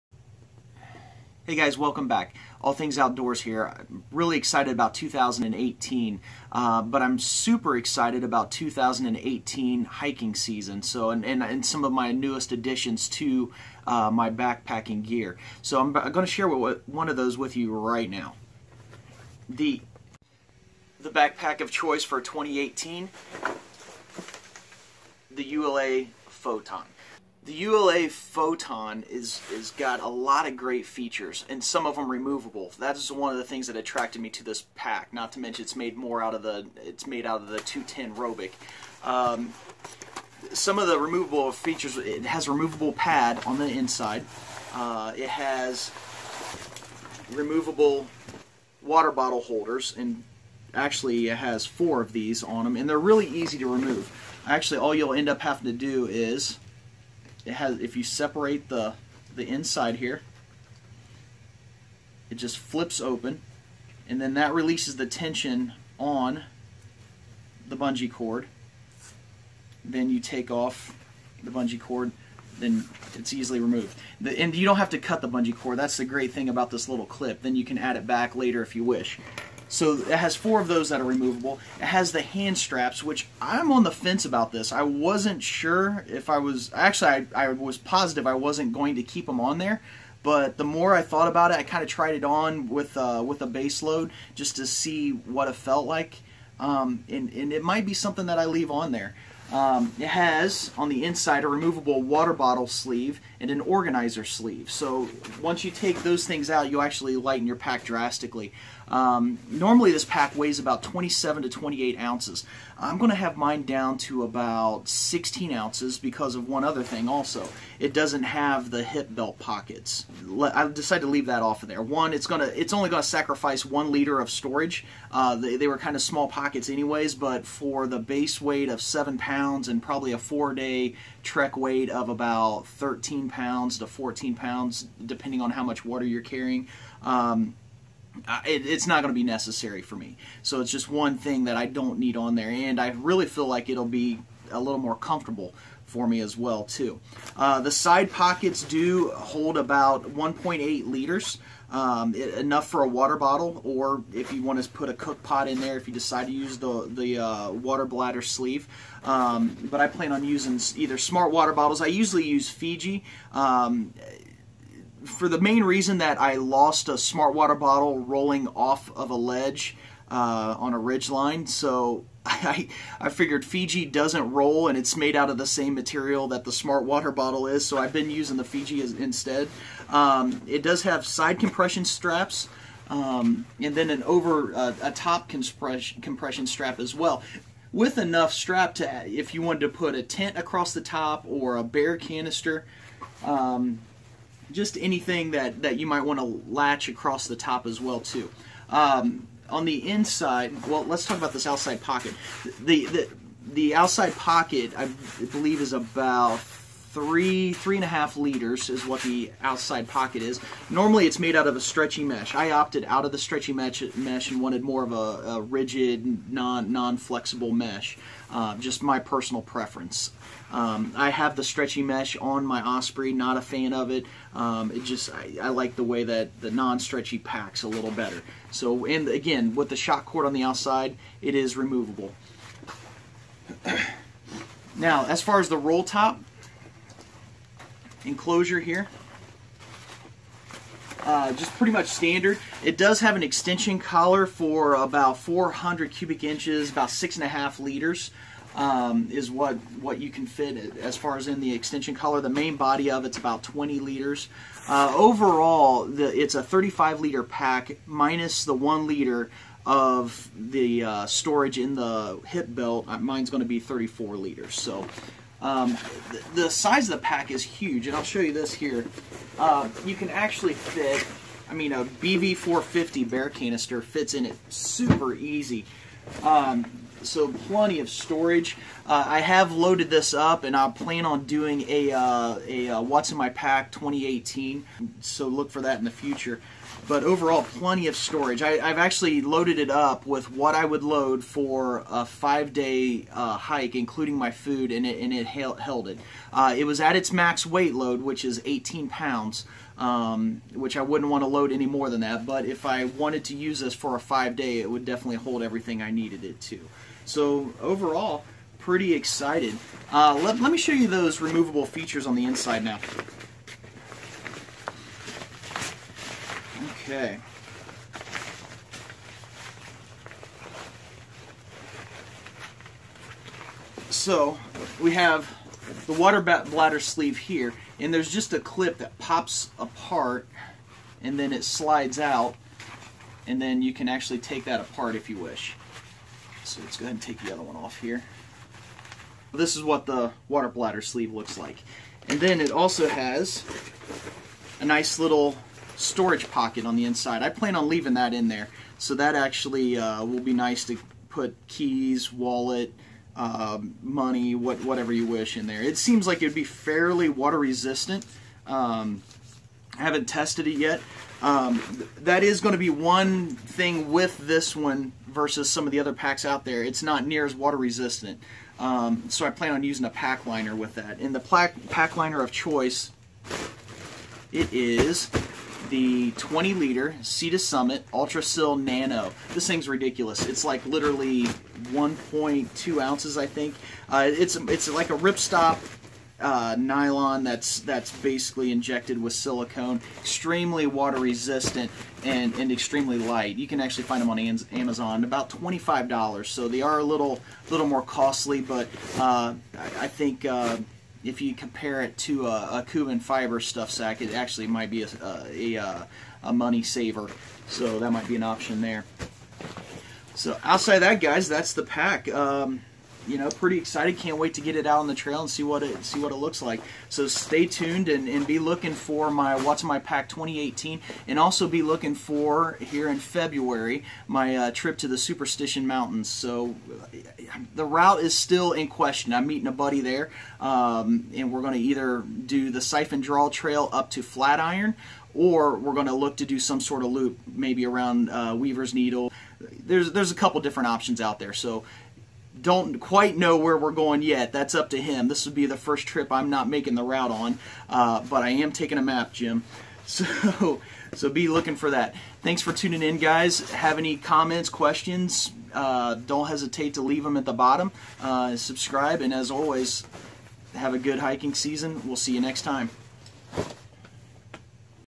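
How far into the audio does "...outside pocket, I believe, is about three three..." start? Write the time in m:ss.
3:23.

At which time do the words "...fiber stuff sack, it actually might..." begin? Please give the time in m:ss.
6:43.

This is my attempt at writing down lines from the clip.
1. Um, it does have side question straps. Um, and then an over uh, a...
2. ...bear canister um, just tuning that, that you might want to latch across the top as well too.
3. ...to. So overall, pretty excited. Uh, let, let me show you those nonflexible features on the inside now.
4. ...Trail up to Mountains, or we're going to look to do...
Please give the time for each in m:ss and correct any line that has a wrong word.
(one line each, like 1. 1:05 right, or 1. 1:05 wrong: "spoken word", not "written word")
1. 2:59 wrong: "compression", not "question"
2. 3:11 wrong: "anything", not "tuning"
3. 5:06 wrong: "removable", not "nonflexible"
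4. 7:13 wrong: "Flatiron", not "Mountains".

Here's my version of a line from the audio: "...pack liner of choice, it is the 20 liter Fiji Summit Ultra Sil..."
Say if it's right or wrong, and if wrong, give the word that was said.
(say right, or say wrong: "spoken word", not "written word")
wrong: "Sea", not "Fiji".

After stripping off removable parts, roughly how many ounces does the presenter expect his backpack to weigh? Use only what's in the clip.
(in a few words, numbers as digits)
16 ounces.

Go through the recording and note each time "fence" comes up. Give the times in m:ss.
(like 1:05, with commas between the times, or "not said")
1:23.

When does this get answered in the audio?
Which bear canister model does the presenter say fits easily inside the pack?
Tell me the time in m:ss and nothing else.
4:31.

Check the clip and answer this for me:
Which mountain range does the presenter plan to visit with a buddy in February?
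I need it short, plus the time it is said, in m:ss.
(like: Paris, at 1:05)
Superstition Mountains, at 7:04.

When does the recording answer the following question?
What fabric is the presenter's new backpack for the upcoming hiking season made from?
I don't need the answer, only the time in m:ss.
0:37.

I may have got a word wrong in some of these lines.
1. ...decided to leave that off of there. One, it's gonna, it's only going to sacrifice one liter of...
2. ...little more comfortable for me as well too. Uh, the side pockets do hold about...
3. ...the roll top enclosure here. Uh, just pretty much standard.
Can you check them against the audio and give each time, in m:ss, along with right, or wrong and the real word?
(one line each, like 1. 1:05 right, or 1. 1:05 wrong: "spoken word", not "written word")
1. 2:00 right
2. 2:24 right
3. 3:55 right.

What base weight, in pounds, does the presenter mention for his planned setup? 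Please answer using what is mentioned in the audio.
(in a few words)
7 pounds.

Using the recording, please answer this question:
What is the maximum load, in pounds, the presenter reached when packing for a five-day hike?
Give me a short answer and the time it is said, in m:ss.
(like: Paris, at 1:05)
18 pounds, at 4:58.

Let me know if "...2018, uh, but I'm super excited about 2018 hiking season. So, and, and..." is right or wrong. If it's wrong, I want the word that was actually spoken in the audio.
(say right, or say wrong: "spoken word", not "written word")
right.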